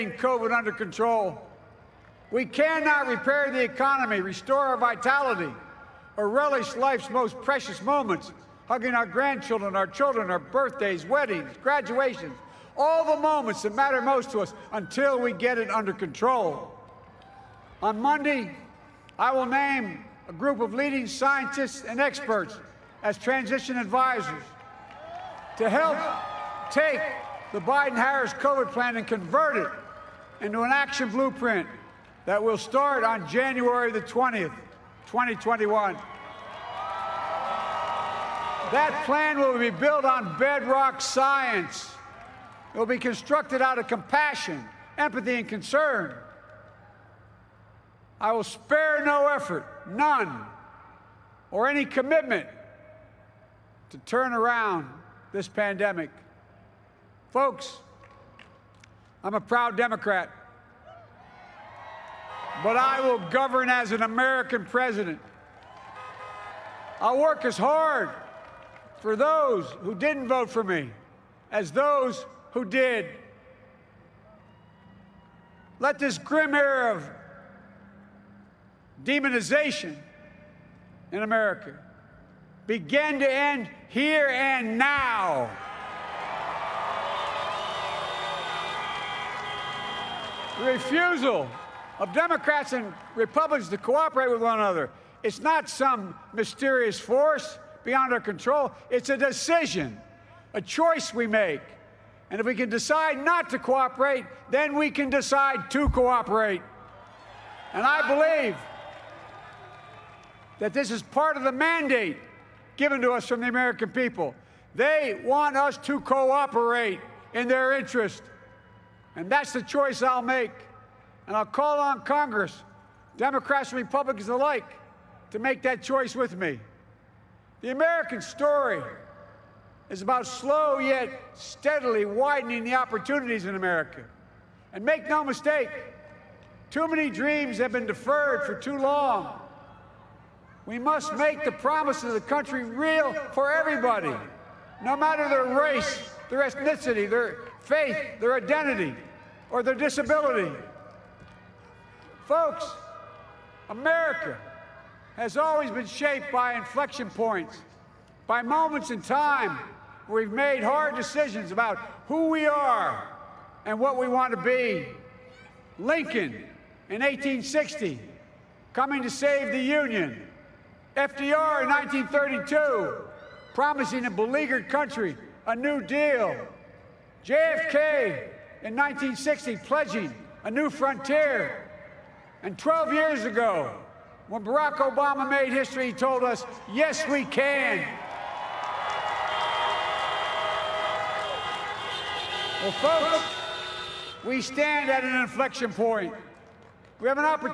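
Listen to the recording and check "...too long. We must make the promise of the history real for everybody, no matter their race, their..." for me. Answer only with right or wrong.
wrong.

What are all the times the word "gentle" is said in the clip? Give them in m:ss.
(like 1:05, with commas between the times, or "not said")
not said.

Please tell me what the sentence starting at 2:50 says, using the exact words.
FDR in 1932 promising a beleaguered country a new deal.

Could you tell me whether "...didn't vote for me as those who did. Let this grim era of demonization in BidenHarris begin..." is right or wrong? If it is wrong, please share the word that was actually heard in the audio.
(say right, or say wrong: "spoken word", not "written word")
wrong: "America", not "BidenHarris".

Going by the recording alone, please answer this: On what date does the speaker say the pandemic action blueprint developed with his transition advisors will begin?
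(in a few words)
January 20, 2021.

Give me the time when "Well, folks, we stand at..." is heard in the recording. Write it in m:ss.
3:12.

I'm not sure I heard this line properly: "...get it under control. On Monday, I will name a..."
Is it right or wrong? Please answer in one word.
right.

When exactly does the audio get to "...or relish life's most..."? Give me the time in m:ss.
0:06.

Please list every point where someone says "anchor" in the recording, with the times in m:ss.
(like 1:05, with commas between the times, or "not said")
not said.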